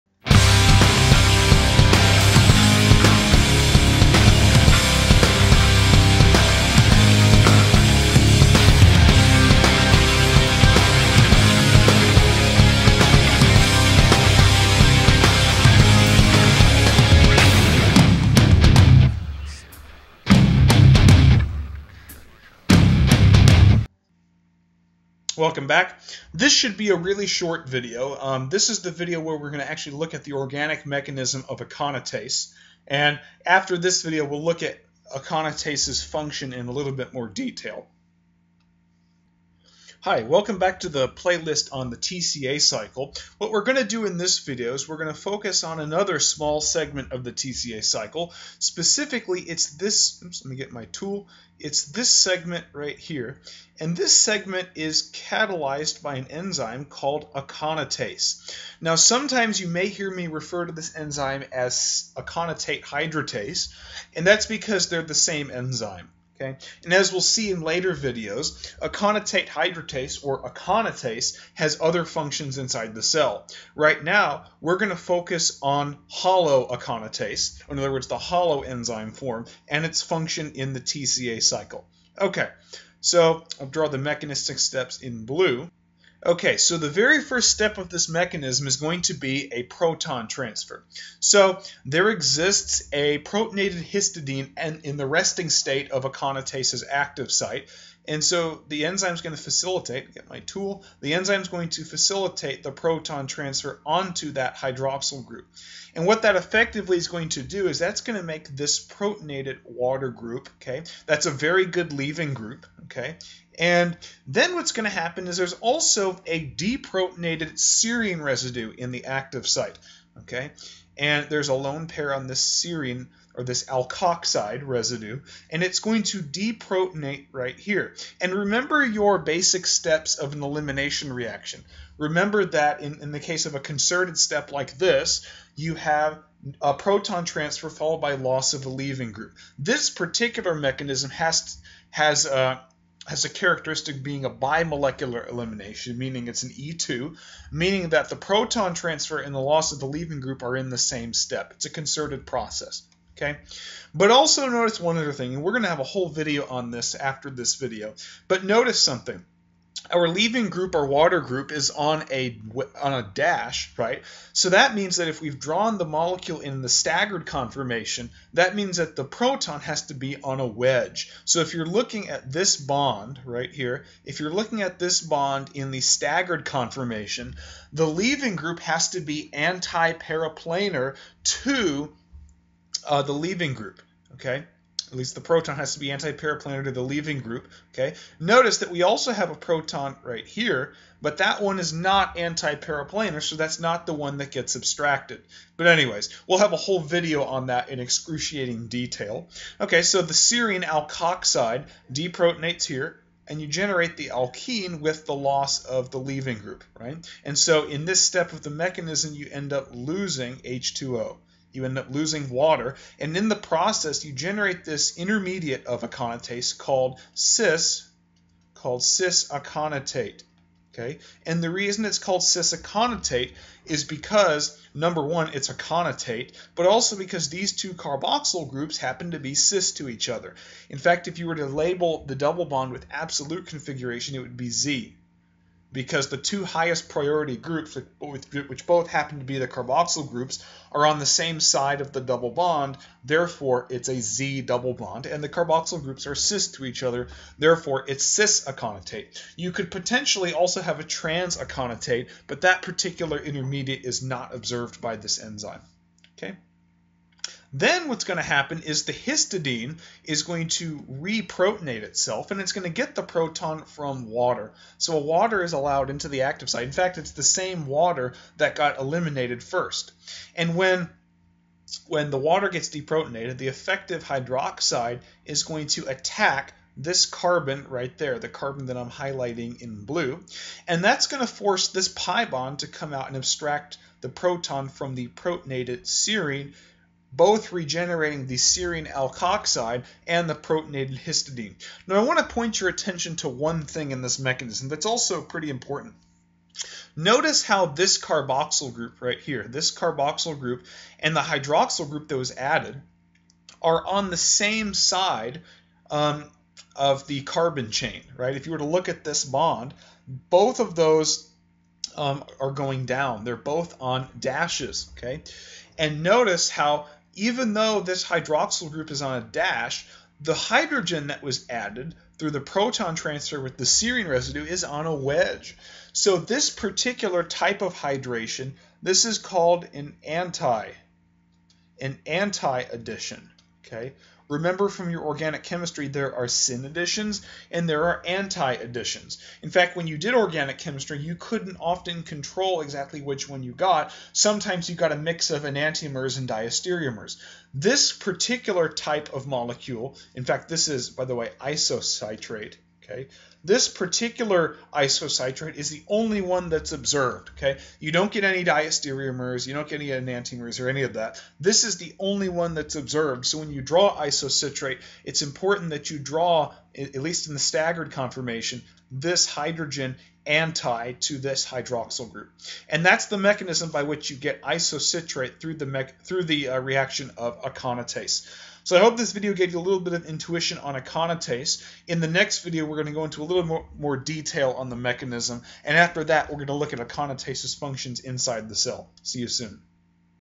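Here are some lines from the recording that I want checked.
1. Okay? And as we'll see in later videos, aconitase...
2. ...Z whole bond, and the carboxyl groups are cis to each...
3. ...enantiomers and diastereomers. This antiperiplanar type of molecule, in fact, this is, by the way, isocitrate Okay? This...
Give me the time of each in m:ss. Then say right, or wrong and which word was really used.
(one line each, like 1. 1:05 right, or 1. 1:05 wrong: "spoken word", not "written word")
1. 1:06 right
2. 4:04 wrong: "double", not "whole"
3. 5:45 wrong: "particular", not "antiperiplanar".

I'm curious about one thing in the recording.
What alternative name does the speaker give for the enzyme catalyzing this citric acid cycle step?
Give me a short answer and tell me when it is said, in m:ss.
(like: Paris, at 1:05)
aconitate hydratase, at 1:02.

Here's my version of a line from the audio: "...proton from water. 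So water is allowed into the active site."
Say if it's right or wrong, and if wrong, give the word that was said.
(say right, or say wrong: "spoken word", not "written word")
right.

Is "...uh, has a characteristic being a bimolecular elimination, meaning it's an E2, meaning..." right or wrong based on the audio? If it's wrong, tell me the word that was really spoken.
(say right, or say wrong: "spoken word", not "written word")
right.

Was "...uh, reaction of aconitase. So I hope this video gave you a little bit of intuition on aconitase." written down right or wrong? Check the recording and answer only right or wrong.
right.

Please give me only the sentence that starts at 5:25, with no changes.
So this particular type of hydration, this is called an anti, an anti addition.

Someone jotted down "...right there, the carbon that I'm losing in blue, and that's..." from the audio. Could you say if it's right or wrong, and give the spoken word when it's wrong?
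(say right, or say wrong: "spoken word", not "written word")
wrong: "highlighting", not "losing".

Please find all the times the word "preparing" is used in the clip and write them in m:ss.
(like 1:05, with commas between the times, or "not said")
not said.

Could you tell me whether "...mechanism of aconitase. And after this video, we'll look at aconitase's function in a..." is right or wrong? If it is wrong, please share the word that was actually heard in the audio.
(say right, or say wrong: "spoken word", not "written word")
right.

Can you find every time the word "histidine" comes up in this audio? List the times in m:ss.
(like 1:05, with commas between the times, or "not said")
1:33, 4:18, 4:50.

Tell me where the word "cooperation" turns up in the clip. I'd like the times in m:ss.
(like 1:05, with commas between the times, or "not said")
not said.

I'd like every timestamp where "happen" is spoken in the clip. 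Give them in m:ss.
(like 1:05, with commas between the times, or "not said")
1:54, 3:48, 3:58, 4:18.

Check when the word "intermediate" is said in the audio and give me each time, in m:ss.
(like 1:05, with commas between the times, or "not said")
3:34, 4:13.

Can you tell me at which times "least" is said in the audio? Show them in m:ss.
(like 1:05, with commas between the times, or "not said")
3:04, 6:06.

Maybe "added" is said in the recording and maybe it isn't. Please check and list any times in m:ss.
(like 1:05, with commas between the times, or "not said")
5:02, 5:21.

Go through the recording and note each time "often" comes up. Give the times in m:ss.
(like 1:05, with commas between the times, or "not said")
5:41.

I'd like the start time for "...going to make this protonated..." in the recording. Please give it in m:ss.
1:48.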